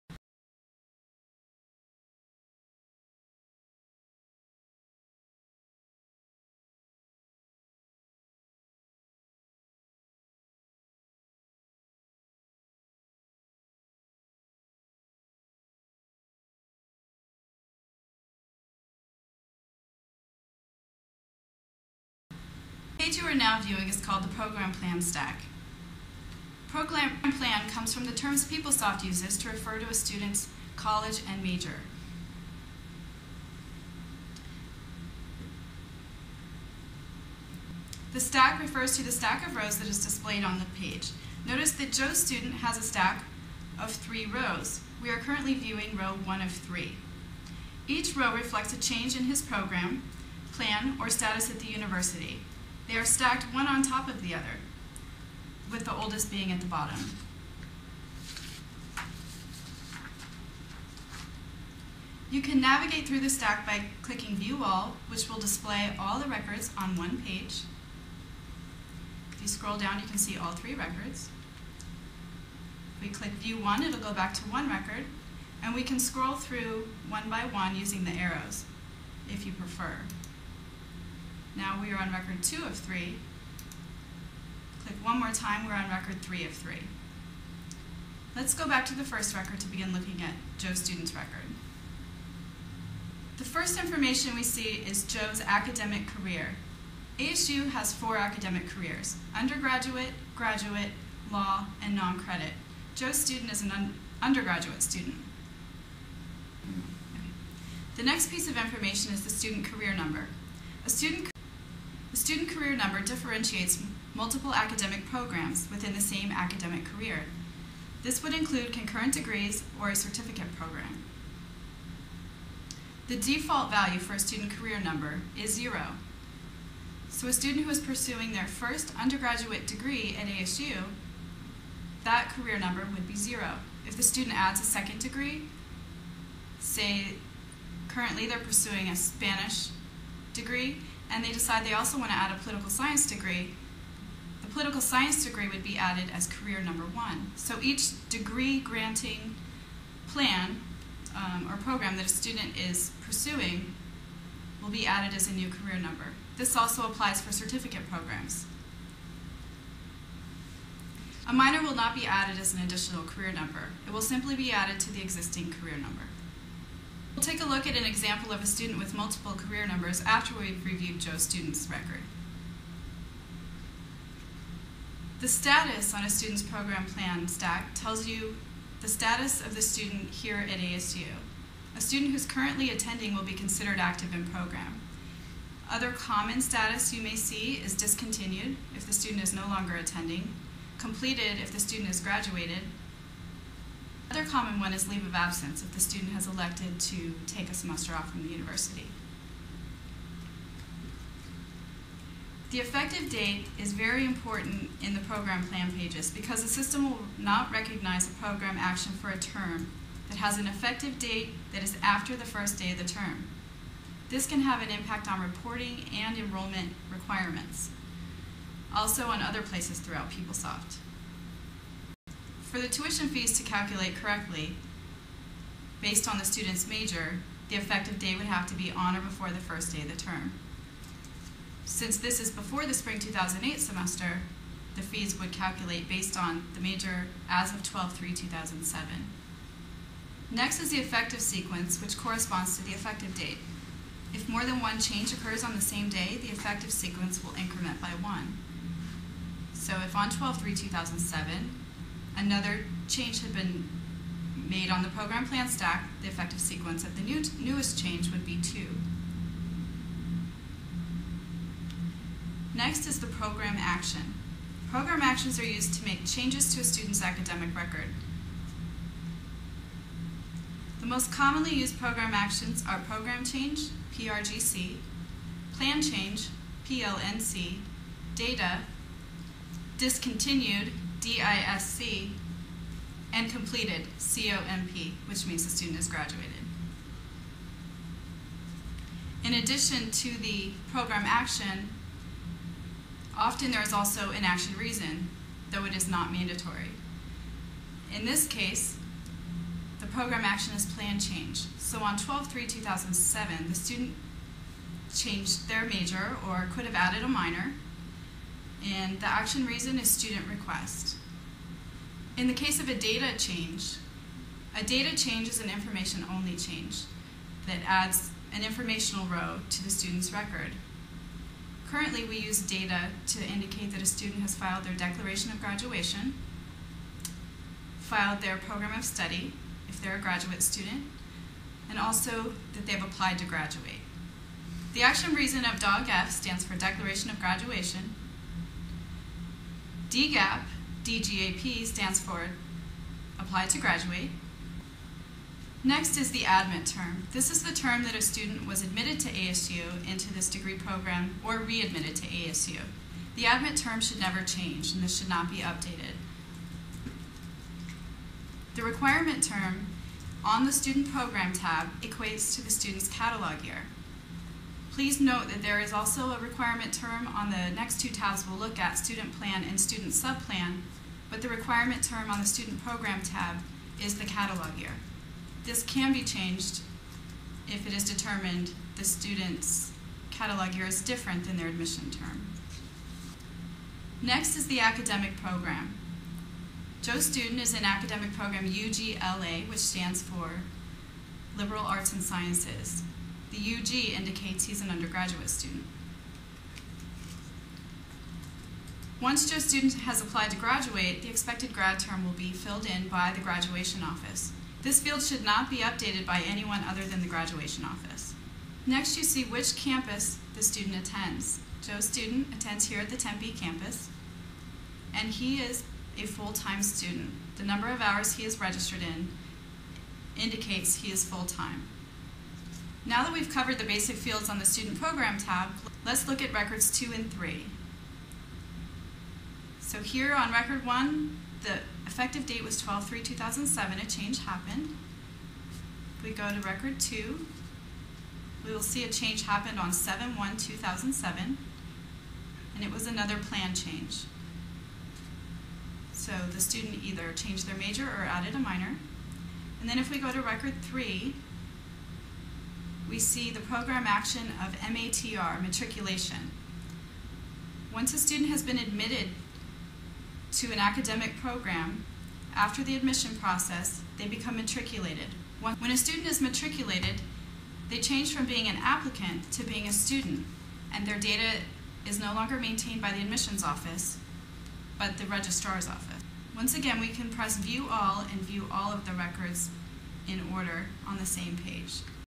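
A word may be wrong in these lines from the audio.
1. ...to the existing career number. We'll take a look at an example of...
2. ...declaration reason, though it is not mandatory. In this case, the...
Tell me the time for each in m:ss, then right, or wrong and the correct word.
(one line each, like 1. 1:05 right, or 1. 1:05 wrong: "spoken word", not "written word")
1. 2:44 right
2. 4:54 wrong: "action", not "declaration".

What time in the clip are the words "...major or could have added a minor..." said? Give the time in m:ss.
5:05.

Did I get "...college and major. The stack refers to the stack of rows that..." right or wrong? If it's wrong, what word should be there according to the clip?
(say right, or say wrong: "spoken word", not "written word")
right.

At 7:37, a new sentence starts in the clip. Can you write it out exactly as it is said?
Once a student has been admitted to an academic program, after the admission process, they become matriculated.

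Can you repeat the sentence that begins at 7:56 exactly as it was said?
Once again, we can press View All and view all of the records in order on the same page.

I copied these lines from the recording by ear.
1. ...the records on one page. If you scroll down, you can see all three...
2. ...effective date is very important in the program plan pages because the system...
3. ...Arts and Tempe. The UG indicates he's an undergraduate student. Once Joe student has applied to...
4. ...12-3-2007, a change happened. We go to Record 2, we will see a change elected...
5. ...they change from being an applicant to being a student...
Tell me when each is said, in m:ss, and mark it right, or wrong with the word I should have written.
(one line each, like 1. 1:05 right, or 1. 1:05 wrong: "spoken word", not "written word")
1. 1:06 right
2. 3:22 right
3. 6:31 wrong: "Sciences", not "Tempe"
4. 7:12 wrong: "happened", not "elected"
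5. 7:47 right.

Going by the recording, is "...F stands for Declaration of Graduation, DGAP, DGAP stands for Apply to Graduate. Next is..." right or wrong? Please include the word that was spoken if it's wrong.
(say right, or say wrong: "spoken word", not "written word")
right.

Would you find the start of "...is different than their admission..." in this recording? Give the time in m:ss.
6:20.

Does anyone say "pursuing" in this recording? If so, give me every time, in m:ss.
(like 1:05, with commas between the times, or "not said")
2:07, 2:18, 2:33.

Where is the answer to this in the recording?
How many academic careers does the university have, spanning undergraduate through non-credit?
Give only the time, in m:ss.
1:37.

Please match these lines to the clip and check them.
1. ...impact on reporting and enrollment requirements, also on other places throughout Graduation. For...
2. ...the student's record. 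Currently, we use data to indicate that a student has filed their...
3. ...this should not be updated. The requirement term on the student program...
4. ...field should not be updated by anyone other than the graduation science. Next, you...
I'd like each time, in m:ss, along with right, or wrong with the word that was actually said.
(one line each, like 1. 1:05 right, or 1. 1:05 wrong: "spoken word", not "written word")
1. 3:34 wrong: "PeopleSoft", not "Graduation"
2. 5:19 right
3. 5:54 right
4. 6:44 wrong: "office", not "science".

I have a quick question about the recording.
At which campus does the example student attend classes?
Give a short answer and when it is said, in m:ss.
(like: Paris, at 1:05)
Tempe, at 6:52.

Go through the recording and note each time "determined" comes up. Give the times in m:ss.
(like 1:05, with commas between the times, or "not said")
6:17.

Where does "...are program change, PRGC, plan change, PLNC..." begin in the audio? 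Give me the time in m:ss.
4:32.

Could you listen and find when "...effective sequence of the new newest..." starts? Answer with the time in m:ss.
4:16.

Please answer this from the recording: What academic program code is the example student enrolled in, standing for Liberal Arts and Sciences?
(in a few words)
UGLA.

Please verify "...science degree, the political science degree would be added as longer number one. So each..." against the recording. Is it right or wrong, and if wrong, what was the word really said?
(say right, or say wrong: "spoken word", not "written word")
wrong: "career", not "longer".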